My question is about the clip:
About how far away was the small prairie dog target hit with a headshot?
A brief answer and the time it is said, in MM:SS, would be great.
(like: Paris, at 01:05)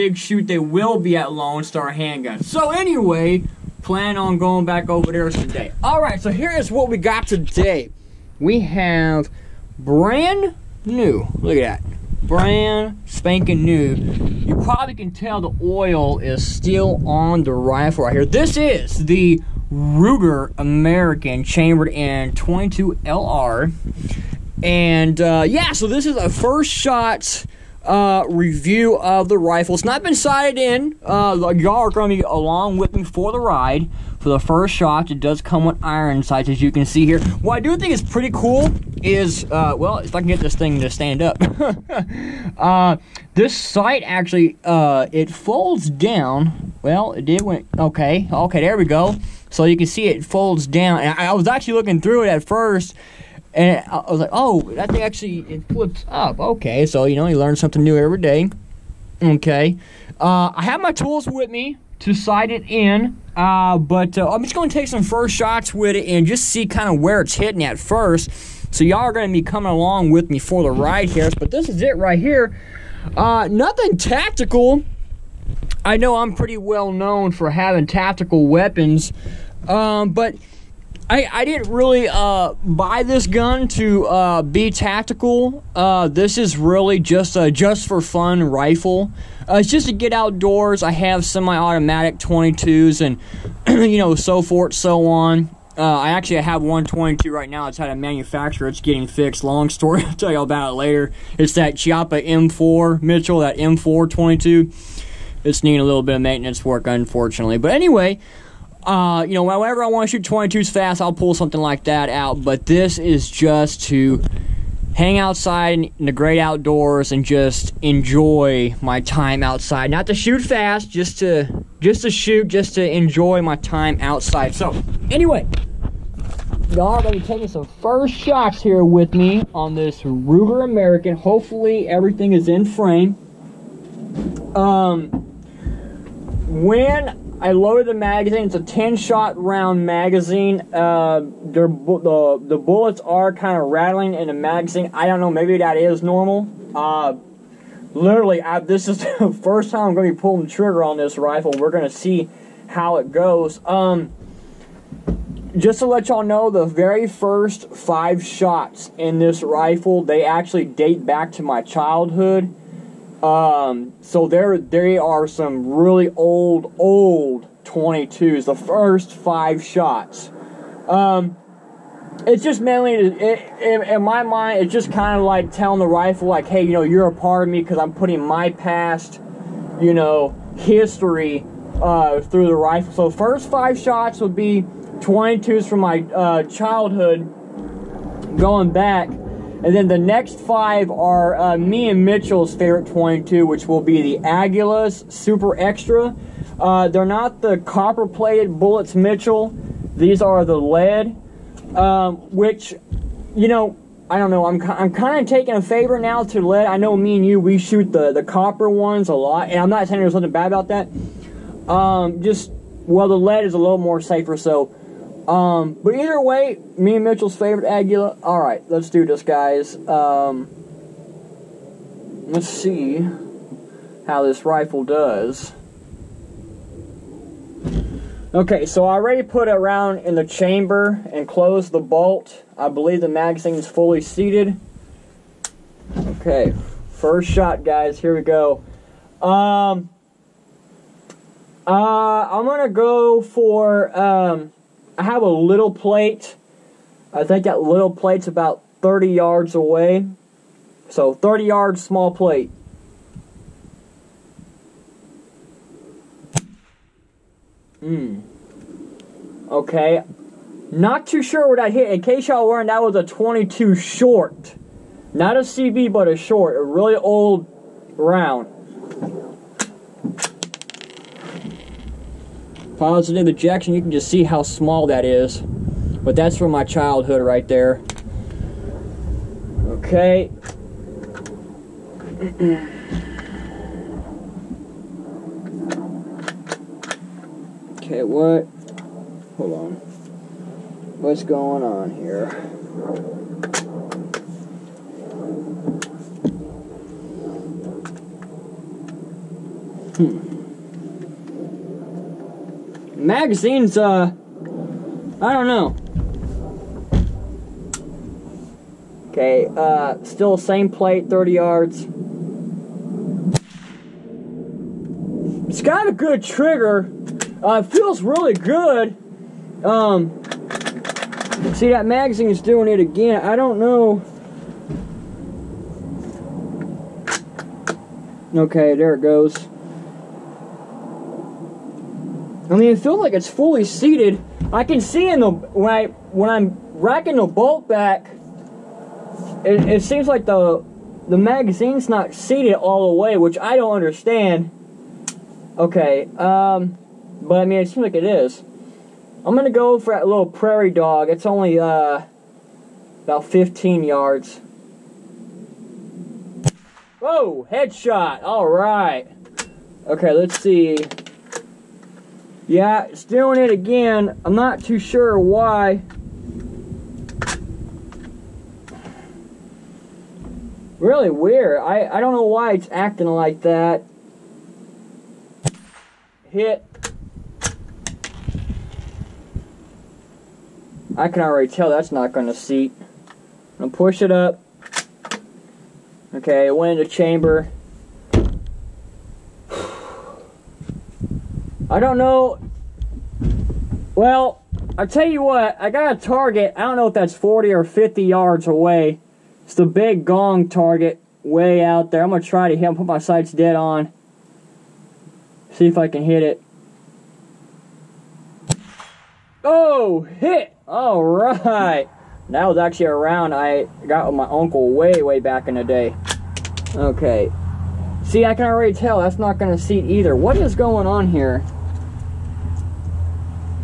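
15 yards, at 05:53.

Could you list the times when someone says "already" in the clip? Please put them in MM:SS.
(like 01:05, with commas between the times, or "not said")
03:48, 06:21, 06:58.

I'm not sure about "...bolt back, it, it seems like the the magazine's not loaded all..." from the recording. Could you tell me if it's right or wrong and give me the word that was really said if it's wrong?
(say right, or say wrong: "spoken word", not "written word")
wrong: "seated", not "loaded".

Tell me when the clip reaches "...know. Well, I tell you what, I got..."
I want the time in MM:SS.
06:31.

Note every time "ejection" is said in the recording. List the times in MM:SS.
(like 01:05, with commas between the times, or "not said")
04:33.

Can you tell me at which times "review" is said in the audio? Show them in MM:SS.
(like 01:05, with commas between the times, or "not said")
00:28.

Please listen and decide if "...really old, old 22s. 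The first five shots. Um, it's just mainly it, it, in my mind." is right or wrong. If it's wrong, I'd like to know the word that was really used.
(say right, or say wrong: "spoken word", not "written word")
right.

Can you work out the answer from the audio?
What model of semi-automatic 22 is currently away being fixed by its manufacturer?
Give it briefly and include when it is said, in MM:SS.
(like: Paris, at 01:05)
Chiappa M4, at 01:41.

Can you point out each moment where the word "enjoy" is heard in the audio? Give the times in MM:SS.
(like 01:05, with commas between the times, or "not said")
01:57, 02:02.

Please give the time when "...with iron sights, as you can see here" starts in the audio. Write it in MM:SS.
00:35.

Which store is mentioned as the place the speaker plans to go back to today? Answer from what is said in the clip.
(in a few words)
Lone Star Handguns.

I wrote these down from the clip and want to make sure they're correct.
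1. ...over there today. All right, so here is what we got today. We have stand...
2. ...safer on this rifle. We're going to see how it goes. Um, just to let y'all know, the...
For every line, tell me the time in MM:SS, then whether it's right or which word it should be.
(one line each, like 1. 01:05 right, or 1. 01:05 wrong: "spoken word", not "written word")
1. 00:04 wrong: "brand", not "stand"
2. 02:30 wrong: "trigger", not "safer".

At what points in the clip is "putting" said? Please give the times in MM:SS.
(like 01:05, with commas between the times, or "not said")
02:57.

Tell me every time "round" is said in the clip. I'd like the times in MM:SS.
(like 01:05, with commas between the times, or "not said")
02:19, 03:49, 04:27, 06:52.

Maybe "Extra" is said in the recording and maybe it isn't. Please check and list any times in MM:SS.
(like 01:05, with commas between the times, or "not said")
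03:15.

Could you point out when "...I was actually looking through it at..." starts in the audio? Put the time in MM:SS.
00:51.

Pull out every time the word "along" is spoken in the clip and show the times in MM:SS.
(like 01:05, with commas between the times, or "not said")
00:32, 01:09.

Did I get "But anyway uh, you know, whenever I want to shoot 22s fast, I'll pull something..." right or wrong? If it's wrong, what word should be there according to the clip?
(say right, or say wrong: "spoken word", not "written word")
right.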